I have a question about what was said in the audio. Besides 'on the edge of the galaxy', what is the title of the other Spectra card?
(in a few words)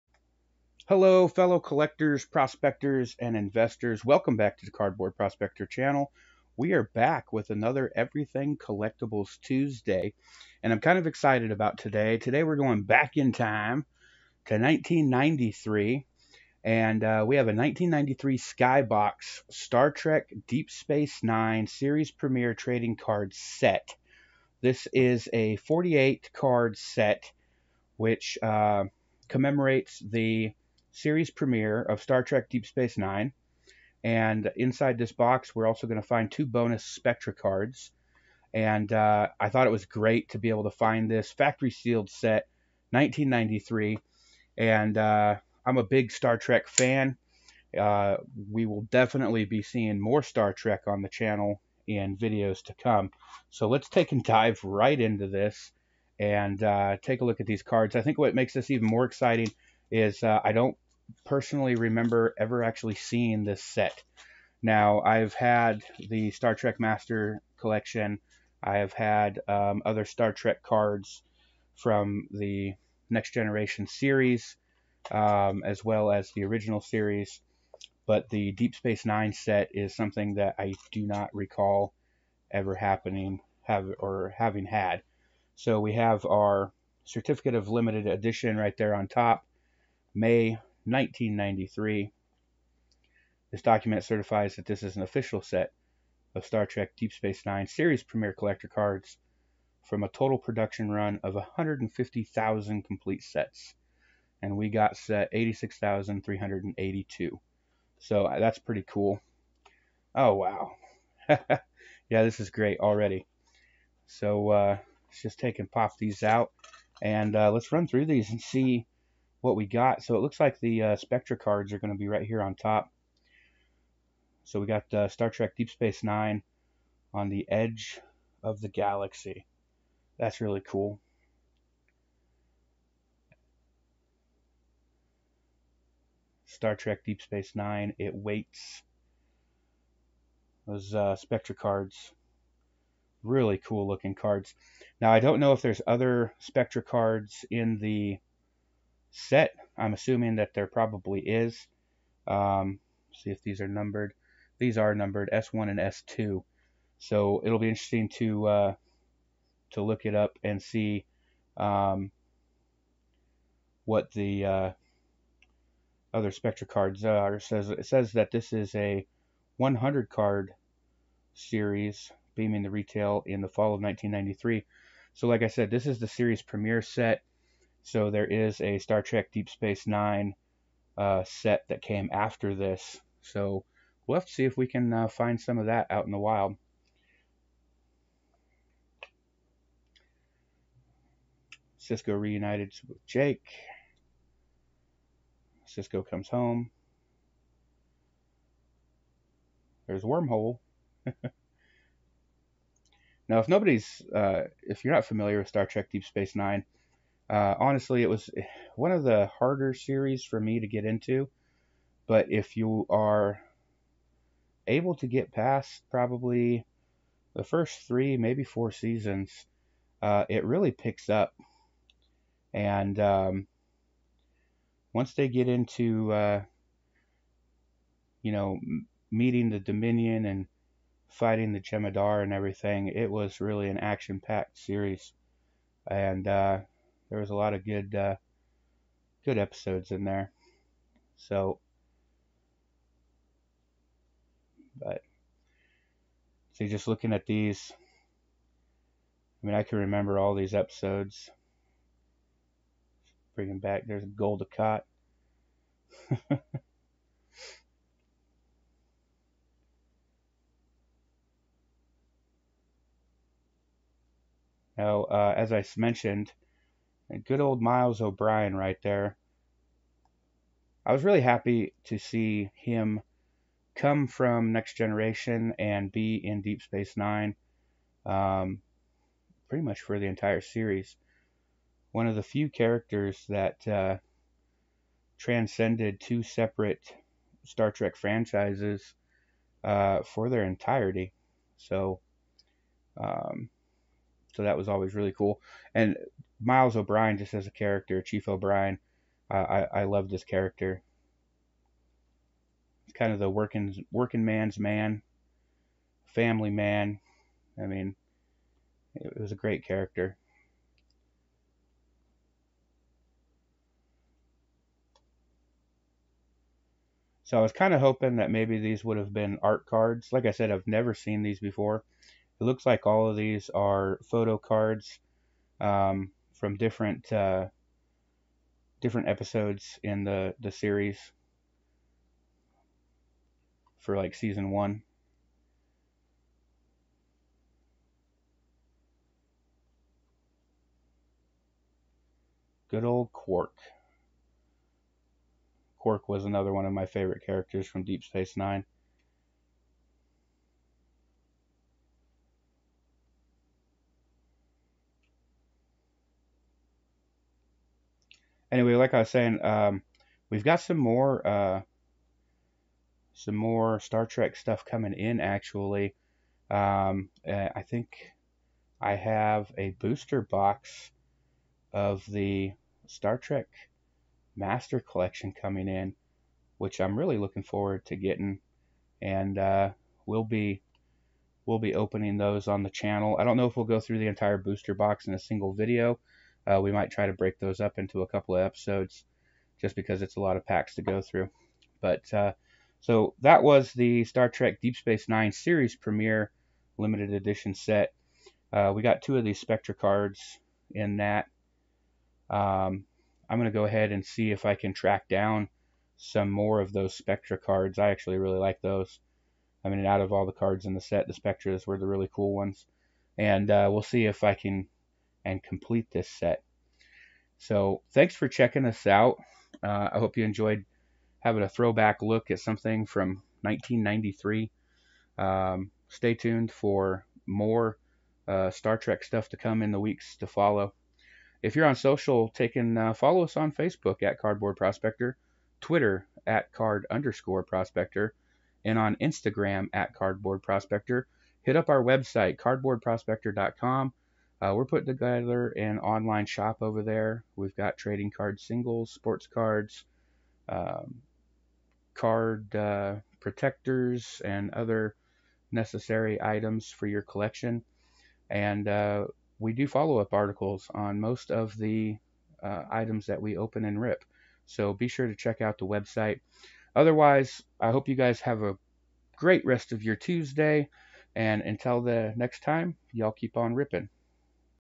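It Waits.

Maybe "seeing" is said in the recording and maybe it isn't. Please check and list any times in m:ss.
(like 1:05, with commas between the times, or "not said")
0:49, 1:02.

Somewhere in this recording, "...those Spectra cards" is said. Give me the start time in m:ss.
6:46.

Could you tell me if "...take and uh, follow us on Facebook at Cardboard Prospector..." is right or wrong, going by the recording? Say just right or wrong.
right.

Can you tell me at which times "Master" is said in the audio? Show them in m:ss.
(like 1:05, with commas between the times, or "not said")
1:06, 6:14.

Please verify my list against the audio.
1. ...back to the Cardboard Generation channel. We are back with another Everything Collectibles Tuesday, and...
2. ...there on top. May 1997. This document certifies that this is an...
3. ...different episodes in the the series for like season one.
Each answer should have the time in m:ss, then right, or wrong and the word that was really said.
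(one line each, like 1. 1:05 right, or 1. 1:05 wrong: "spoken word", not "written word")
1. 0:04 wrong: "Prospector", not "Generation"
2. 1:28 wrong: "1993", not "1997"
3. 5:28 right.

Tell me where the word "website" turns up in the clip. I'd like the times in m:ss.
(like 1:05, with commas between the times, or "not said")
7:21, 7:45.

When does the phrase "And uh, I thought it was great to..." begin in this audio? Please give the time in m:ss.
0:38.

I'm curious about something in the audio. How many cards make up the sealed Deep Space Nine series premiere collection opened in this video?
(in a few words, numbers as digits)
48.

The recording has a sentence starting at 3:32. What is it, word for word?
But if you are able to get past probably the first three, maybe four seasons, uh, it really picks up.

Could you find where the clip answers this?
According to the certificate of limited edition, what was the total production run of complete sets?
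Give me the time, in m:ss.
1:41.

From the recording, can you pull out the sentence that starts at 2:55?
So like I said, this is the series premiere set.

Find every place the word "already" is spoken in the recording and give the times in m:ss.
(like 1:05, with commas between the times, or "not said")
1:52.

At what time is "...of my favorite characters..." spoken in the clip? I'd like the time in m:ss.
5:46.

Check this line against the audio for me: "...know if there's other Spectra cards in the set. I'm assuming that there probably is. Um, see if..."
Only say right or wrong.
right.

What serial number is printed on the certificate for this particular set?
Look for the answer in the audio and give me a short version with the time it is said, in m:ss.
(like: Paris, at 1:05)
86,382, at 1:45.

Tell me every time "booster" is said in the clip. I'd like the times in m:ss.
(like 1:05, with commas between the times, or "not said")
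6:09, 6:24.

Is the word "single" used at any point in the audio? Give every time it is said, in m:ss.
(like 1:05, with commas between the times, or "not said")
6:25, 7:28.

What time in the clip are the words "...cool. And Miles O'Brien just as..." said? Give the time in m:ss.
4:55.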